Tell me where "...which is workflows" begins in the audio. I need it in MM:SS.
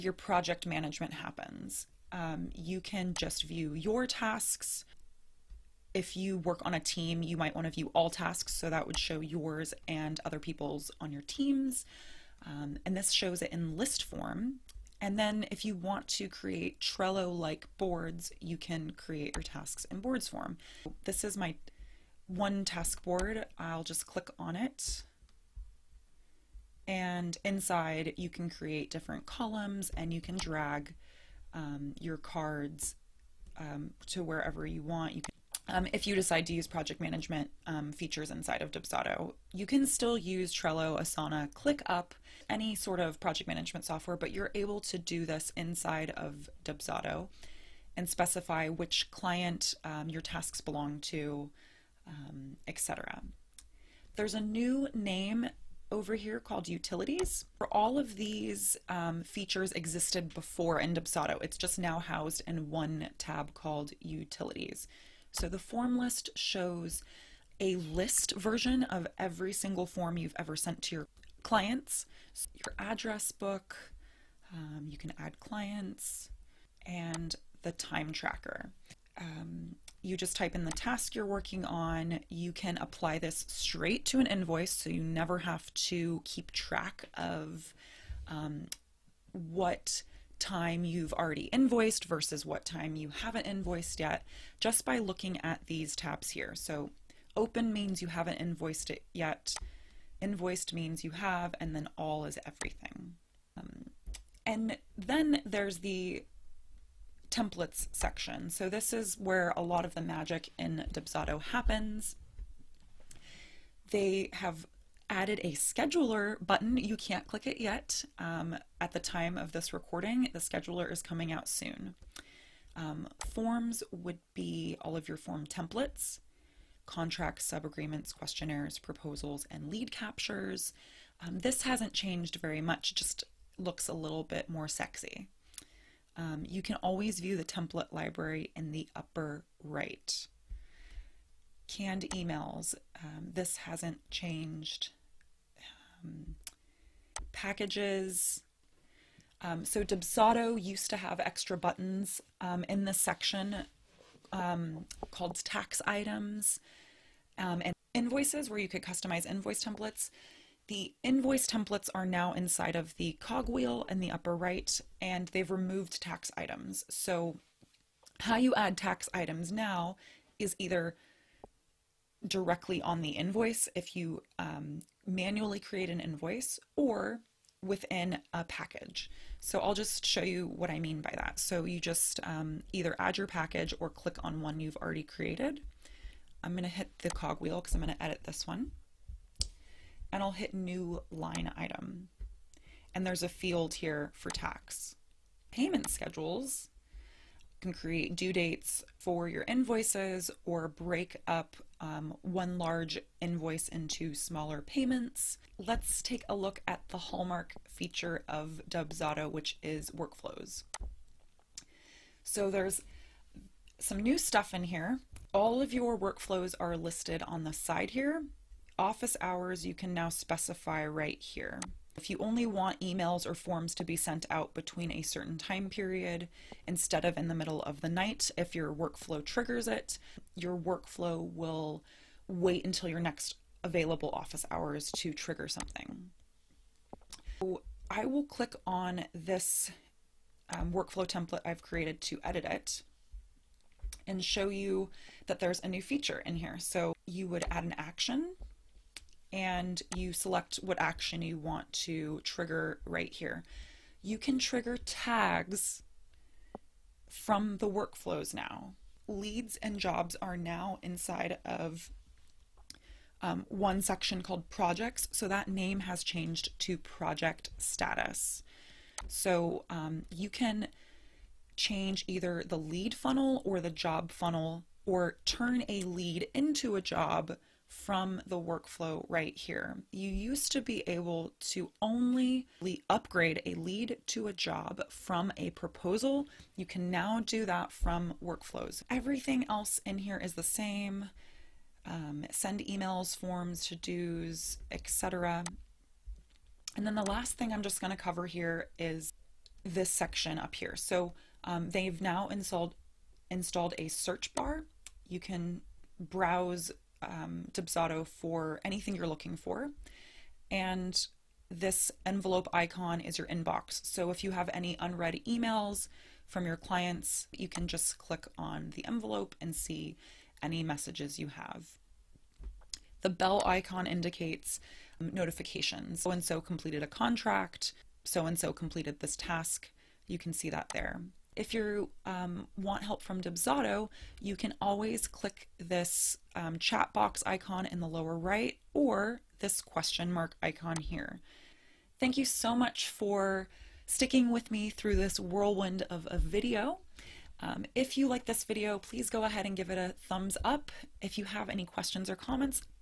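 03:29.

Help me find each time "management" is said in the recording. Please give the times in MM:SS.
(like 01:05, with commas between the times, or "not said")
00:00, 00:36, 00:43.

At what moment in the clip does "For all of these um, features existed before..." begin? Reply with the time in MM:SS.
00:57.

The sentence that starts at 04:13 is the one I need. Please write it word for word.
You can trigger tags from the workflows now.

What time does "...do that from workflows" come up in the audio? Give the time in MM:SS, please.
04:47.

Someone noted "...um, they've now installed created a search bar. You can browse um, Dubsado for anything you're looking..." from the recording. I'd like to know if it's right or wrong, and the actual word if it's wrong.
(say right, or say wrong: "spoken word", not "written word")
wrong: "installed", not "created".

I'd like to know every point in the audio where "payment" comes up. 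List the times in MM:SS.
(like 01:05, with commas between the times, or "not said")
03:15, 03:24.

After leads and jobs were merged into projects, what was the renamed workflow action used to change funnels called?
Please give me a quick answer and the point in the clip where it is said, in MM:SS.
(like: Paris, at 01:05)
Project status, at 04:26.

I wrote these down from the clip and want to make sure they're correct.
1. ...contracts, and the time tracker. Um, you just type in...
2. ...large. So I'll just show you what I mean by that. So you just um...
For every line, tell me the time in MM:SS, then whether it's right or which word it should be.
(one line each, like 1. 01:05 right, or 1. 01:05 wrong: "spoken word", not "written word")
1. 01:15 wrong: "clients", not "contracts"
2. 02:58 wrong: "package", not "large".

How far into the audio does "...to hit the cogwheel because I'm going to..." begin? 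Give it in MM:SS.
03:06.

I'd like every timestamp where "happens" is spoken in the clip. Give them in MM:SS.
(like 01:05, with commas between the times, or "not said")
00:01, 01:51.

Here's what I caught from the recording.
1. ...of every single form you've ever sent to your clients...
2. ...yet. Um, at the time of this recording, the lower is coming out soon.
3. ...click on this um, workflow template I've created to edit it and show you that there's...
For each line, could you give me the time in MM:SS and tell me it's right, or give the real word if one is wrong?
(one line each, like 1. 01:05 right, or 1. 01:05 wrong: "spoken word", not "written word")
1. 01:08 right
2. 01:57 wrong: "scheduler", not "lower"
3. 03:58 right.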